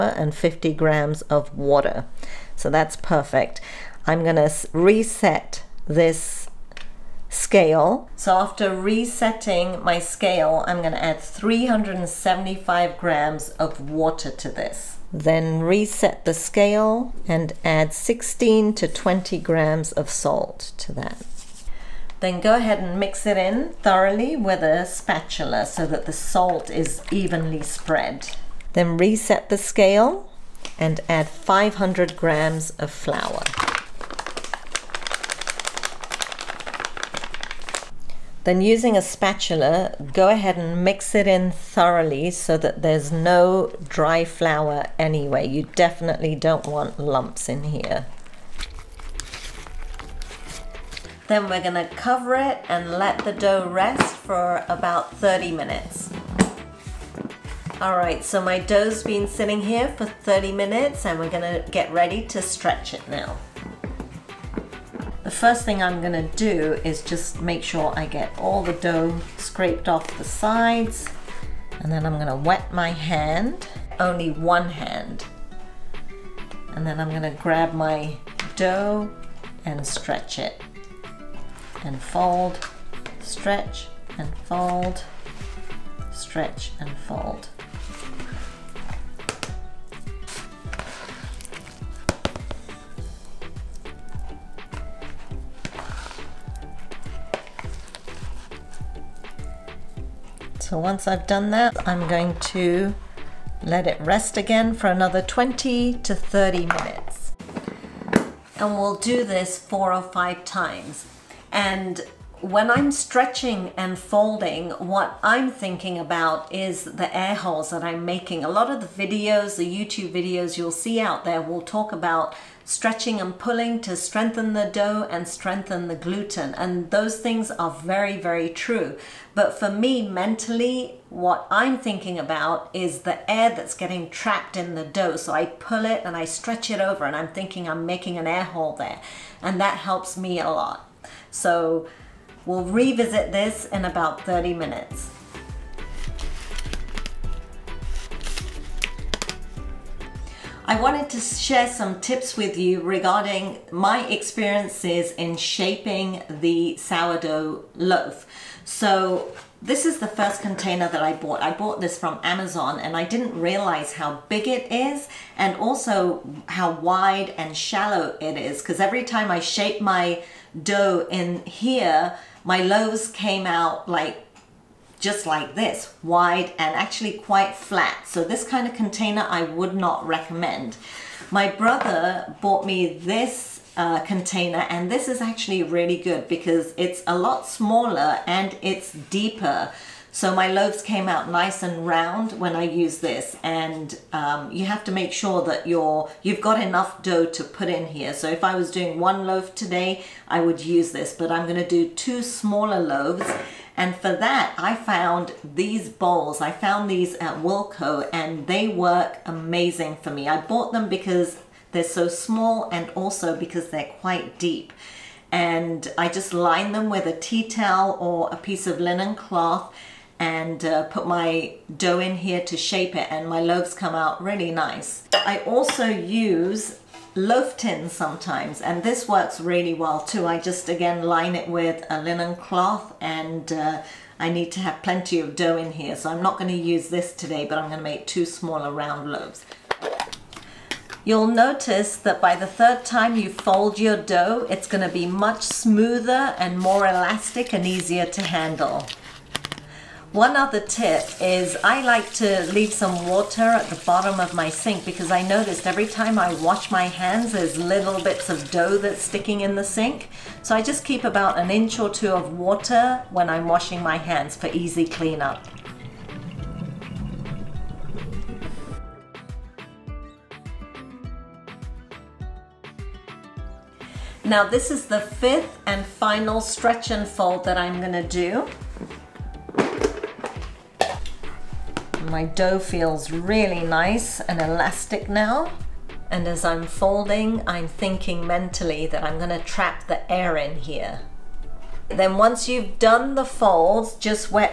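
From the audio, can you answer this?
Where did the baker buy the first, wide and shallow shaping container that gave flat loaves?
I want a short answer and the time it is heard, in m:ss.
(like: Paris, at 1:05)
Amazon, at 2:42.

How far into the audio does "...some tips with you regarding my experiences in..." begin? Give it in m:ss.
2:31.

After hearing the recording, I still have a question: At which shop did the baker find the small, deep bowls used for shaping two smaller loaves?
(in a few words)
Wilko.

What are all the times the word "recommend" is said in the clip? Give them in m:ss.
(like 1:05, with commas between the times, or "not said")
3:00.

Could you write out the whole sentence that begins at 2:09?
But for me, mentally, what I'm thinking about is the air that's getting trapped in the dough.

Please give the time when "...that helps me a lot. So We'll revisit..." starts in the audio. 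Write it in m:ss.
2:19.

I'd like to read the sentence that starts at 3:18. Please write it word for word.
So if I was doing one loaf today, I would use this, but I'm gonna do two smaller loaves.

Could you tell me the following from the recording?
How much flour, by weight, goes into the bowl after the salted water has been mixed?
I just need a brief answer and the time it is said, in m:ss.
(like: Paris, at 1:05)
500 grams, at 0:31.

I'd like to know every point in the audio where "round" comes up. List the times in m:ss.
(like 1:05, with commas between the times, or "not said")
3:11, 3:58.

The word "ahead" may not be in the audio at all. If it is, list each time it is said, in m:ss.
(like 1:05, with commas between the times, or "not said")
0:22, 0:40.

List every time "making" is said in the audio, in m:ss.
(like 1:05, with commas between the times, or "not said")
1:58, 2:17.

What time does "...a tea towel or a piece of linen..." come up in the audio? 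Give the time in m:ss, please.
3:37.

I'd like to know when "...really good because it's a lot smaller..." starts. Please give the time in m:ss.
3:05.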